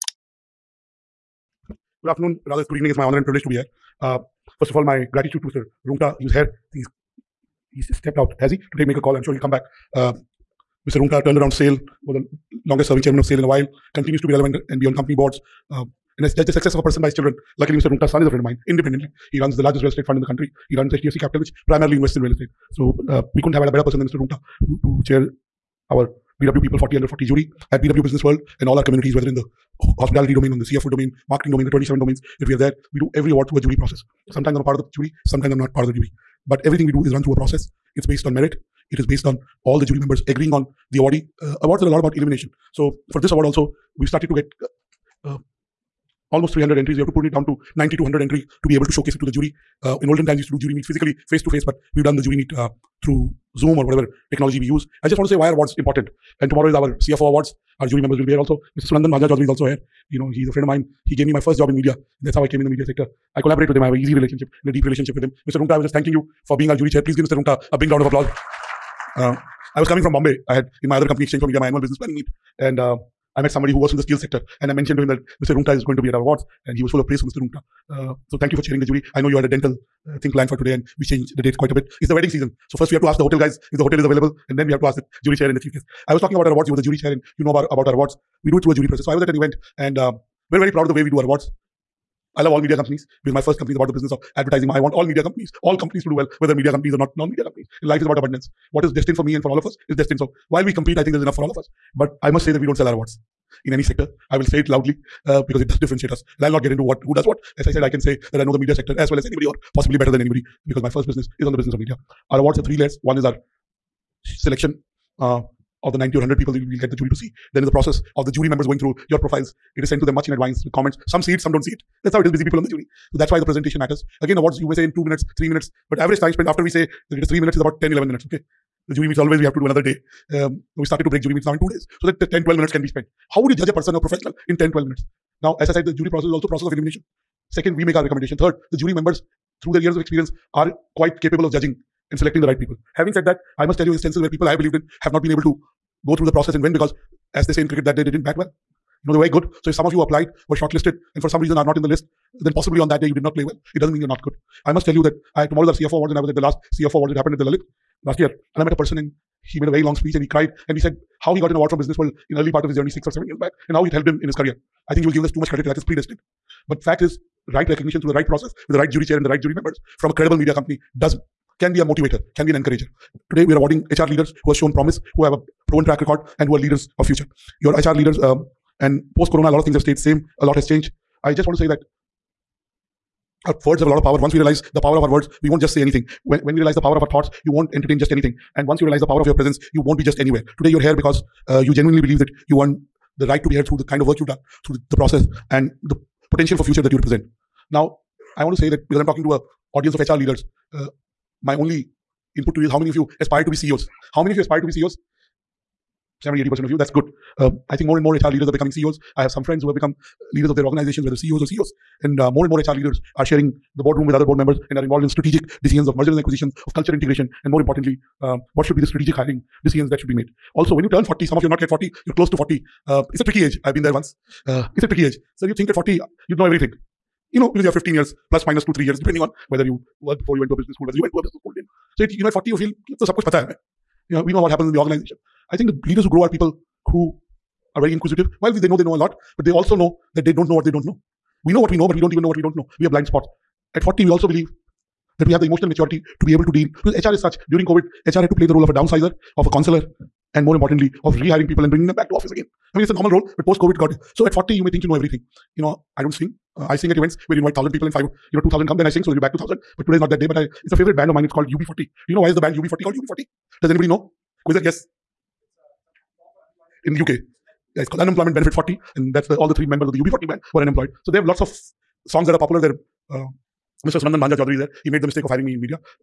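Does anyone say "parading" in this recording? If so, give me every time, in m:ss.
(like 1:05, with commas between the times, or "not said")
not said.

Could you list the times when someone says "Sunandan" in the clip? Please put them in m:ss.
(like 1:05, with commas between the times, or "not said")
0:58, 4:33.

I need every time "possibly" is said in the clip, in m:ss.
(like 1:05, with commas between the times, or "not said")
1:49, 2:32.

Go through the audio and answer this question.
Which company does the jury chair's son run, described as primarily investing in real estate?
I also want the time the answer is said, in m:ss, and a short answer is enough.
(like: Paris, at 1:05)
HDFC Capital, at 0:20.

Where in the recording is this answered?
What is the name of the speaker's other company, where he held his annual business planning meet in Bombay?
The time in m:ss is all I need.
1:11.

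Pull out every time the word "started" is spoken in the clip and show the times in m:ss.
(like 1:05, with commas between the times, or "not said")
0:44, 2:10.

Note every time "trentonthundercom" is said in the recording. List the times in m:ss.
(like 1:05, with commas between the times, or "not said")
not said.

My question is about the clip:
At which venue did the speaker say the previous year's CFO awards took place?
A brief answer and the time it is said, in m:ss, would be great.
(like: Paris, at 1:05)
the Lalit, at 2:37.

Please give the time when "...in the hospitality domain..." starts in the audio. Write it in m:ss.
0:29.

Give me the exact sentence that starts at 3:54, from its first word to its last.
You know, we know what happens in the organization.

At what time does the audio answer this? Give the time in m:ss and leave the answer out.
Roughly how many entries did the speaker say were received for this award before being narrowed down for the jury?
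0:46.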